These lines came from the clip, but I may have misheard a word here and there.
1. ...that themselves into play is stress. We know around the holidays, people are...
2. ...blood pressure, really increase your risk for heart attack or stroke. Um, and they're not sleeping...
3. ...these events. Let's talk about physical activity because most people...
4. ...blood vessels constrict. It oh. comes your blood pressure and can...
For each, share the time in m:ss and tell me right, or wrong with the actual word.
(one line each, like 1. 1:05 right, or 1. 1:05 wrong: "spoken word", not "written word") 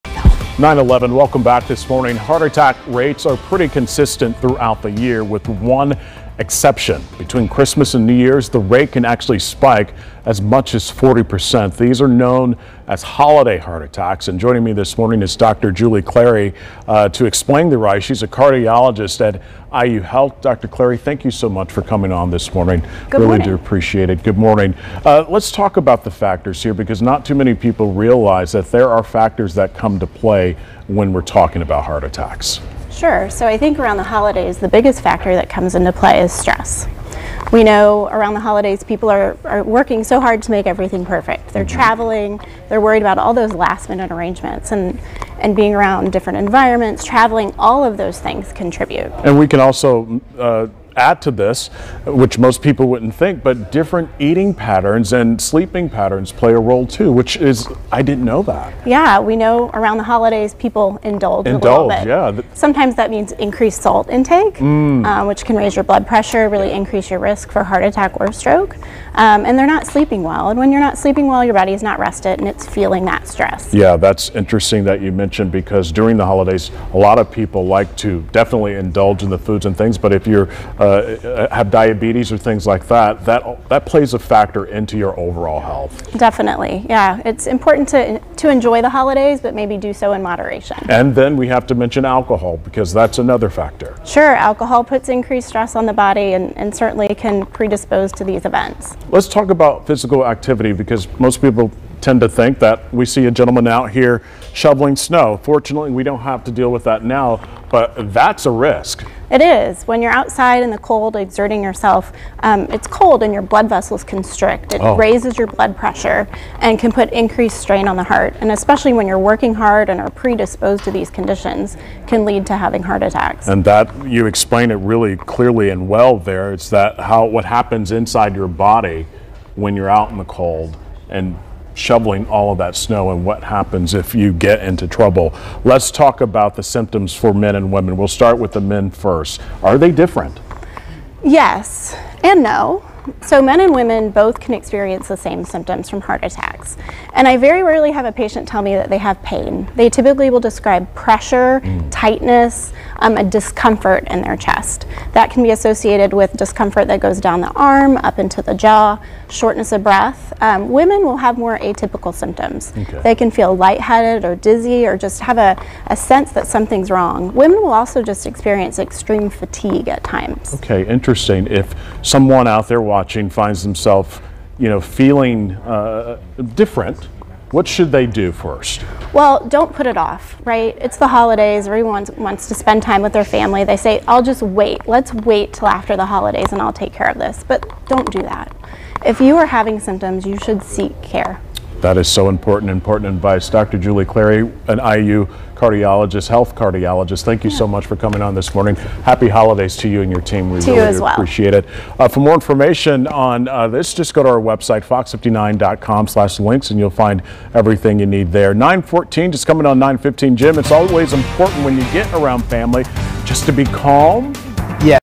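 1. 0:35 wrong: "comes", not "themselves"
2. 1:05 right
3. 1:38 right
4. 1:53 wrong: "raises", not "comes".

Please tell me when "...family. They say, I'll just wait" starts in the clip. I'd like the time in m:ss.
3:03.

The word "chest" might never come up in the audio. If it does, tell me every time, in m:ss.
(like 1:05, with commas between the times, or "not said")
2:34.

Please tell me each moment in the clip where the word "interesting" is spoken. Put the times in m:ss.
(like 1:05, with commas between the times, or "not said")
1:14, 2:50.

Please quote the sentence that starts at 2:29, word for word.
They typically will describe pressure, mm.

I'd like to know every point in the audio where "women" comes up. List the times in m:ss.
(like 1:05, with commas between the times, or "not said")
2:17, 2:23, 2:40, 2:47.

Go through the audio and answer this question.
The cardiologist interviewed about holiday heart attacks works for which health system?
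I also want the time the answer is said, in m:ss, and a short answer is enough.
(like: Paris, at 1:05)
IU Health, at 0:19.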